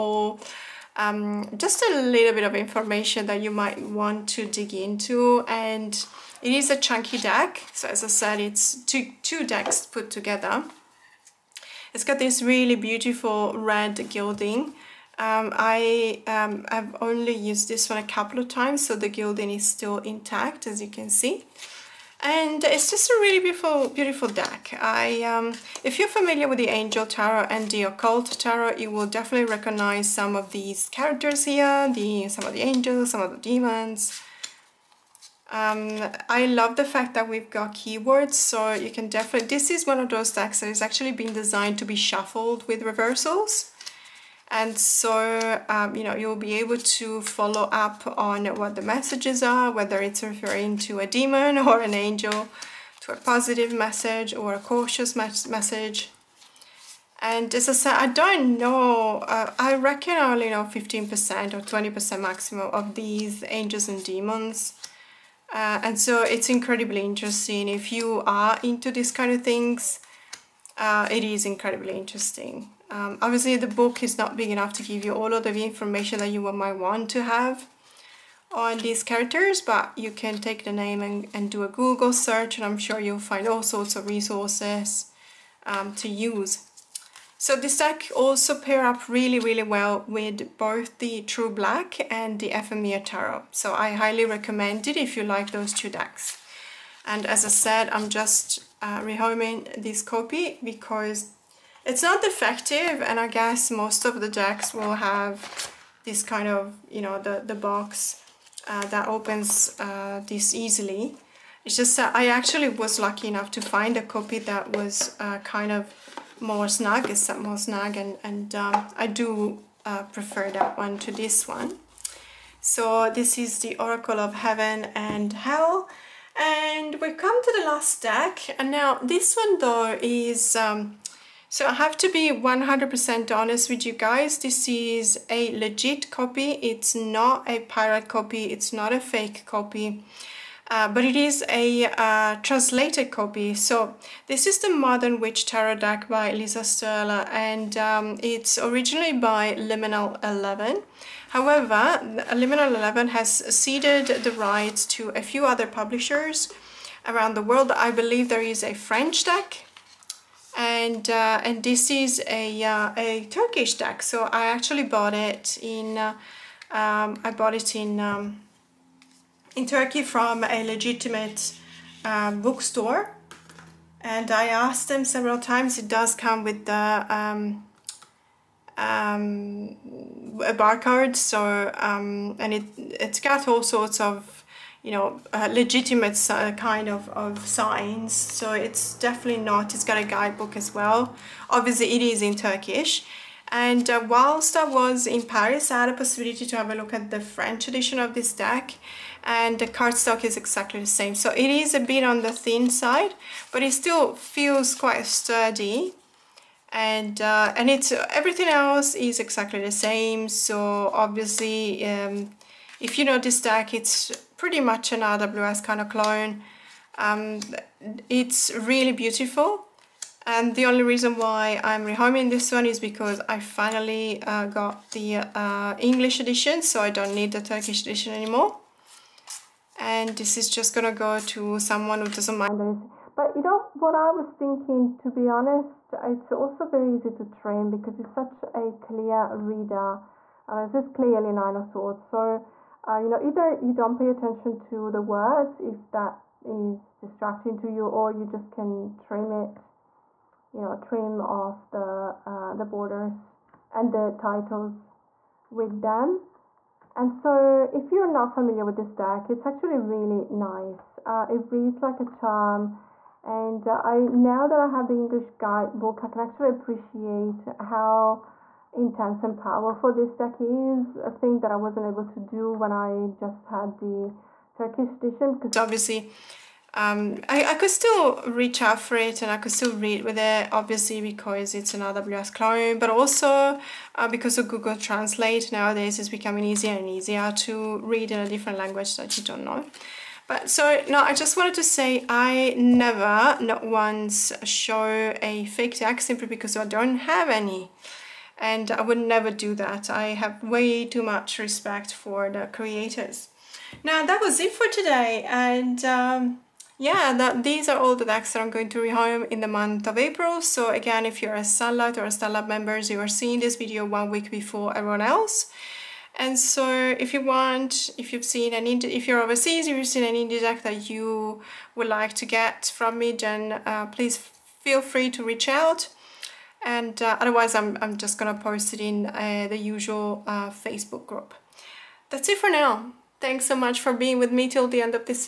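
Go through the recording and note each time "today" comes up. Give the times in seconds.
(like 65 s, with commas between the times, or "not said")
304 s.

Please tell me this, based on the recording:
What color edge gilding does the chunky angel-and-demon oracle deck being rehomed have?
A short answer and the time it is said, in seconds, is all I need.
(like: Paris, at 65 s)
Red, at 13 s.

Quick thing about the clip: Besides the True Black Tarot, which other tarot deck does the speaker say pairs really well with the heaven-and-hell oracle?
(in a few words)
Ephemera Tarot.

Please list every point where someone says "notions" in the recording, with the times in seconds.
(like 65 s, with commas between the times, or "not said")
not said.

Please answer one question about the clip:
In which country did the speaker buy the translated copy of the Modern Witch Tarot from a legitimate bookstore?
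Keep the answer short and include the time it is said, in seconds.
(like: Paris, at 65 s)
Turkey, at 169 s.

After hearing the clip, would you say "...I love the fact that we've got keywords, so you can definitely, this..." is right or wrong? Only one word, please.
right.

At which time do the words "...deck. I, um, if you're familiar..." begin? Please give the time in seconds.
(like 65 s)
24 s.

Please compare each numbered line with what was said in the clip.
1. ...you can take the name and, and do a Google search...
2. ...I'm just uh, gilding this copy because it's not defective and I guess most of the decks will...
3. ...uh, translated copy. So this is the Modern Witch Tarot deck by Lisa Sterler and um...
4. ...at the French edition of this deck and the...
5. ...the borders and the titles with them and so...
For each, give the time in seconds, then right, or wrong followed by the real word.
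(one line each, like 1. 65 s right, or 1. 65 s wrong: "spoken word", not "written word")
1. 79 s right
2. 97 s wrong: "rehoming", not "gilding"
3. 141 s right
4. 196 s right
5. 252 s right.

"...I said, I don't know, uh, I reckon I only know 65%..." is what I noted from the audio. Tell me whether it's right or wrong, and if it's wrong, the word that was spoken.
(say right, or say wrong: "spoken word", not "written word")
wrong: "15", not "65".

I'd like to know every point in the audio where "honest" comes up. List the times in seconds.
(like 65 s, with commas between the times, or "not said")
133 s, 235 s.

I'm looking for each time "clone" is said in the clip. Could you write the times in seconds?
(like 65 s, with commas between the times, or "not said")
215 s, 282 s.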